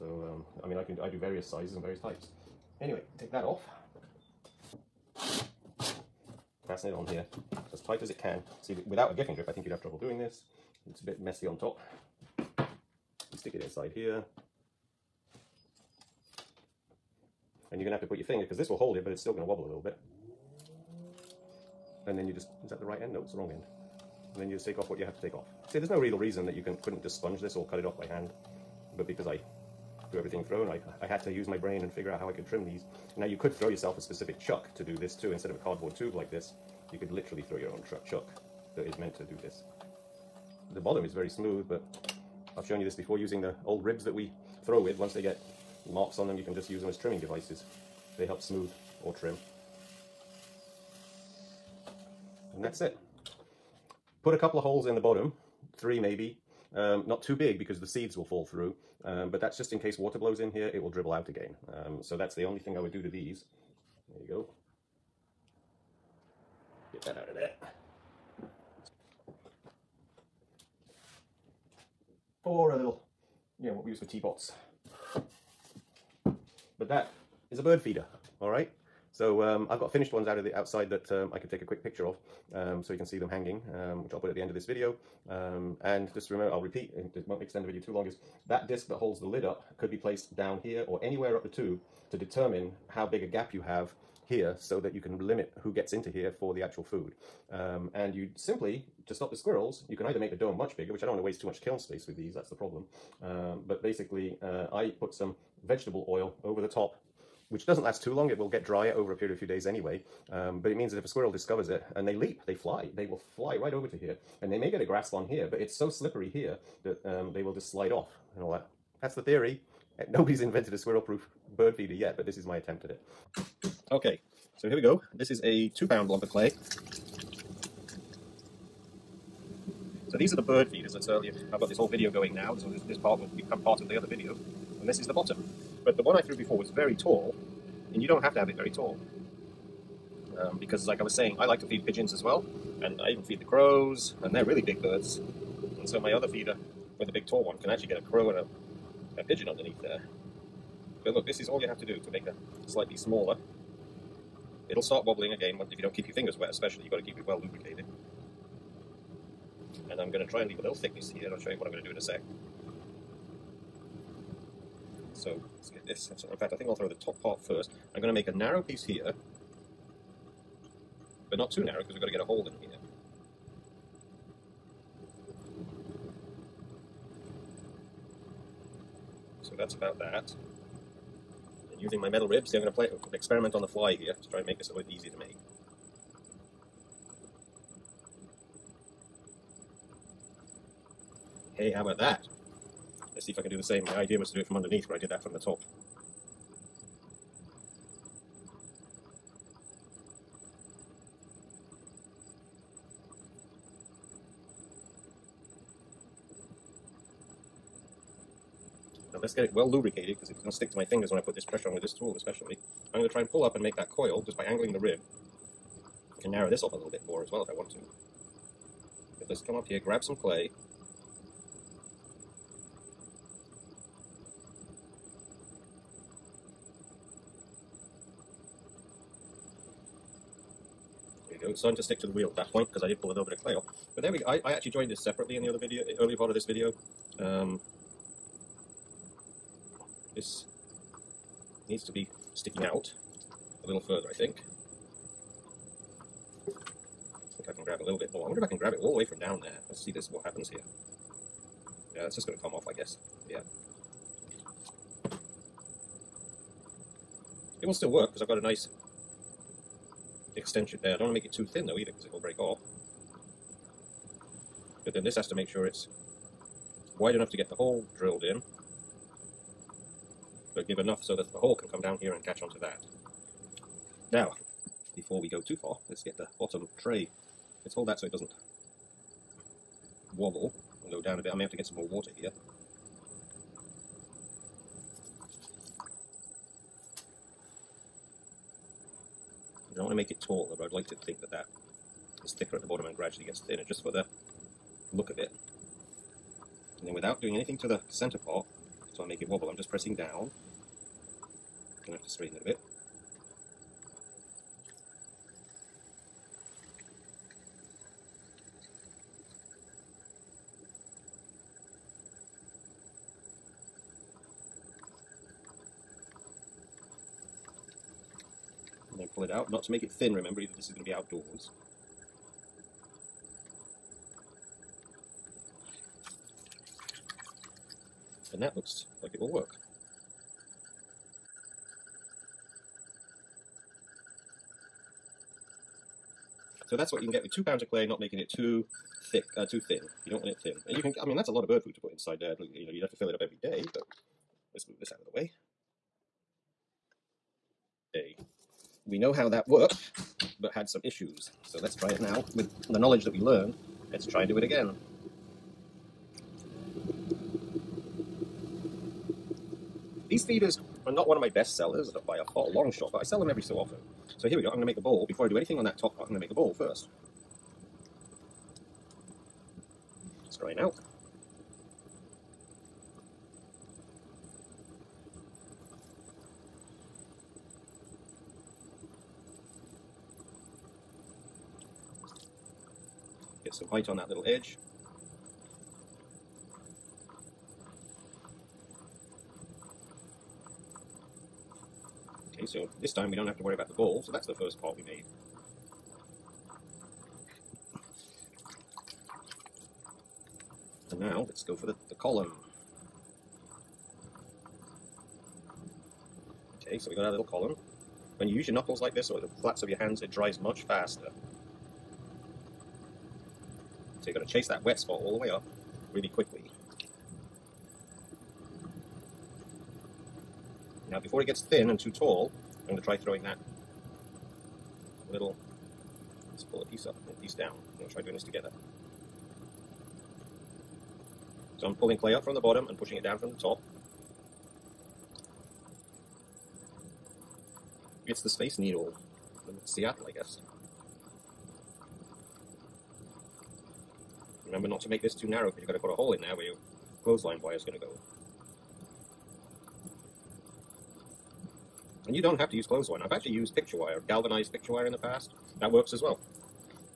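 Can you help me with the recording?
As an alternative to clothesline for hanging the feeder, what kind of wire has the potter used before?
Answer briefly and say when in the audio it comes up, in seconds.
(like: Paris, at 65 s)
Galvanized picture wire, at 454 s.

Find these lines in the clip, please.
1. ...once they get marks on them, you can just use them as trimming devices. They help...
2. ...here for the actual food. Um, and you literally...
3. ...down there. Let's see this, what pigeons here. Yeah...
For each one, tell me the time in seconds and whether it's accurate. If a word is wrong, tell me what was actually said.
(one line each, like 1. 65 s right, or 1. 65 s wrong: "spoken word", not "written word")
1. 44 s right
2. 96 s wrong: "simply", not "literally"
3. 249 s wrong: "happens", not "pigeons".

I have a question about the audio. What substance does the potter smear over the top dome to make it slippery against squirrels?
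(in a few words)
Vegetable oil.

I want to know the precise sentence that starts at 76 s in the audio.
But that is a bird feeder, all right?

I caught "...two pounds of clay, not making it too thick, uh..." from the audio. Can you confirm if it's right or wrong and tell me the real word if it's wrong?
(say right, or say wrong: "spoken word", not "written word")
right.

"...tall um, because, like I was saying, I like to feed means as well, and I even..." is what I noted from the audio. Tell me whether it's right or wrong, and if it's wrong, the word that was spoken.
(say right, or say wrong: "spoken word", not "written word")
wrong: "pigeons", not "means".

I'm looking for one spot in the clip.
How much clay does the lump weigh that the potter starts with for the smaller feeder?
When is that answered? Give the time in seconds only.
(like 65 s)
125 s.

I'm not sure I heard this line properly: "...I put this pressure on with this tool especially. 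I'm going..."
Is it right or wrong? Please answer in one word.
right.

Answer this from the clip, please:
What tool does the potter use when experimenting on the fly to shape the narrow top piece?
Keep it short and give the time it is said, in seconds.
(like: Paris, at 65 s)
Metal ribs, at 182 s.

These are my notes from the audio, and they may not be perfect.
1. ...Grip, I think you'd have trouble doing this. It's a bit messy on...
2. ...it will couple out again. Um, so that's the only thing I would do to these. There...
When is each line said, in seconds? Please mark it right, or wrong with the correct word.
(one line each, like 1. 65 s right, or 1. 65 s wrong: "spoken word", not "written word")
1. 9 s right
2. 60 s wrong: "dribble", not "couple".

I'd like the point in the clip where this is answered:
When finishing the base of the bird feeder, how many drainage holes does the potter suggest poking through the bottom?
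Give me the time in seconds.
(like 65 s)
55 s.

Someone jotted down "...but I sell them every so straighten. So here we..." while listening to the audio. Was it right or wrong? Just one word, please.
wrong.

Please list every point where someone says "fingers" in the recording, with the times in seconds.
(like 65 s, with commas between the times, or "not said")
18 s, 156 s, 210 s.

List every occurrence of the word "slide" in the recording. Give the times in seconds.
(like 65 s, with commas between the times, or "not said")
117 s.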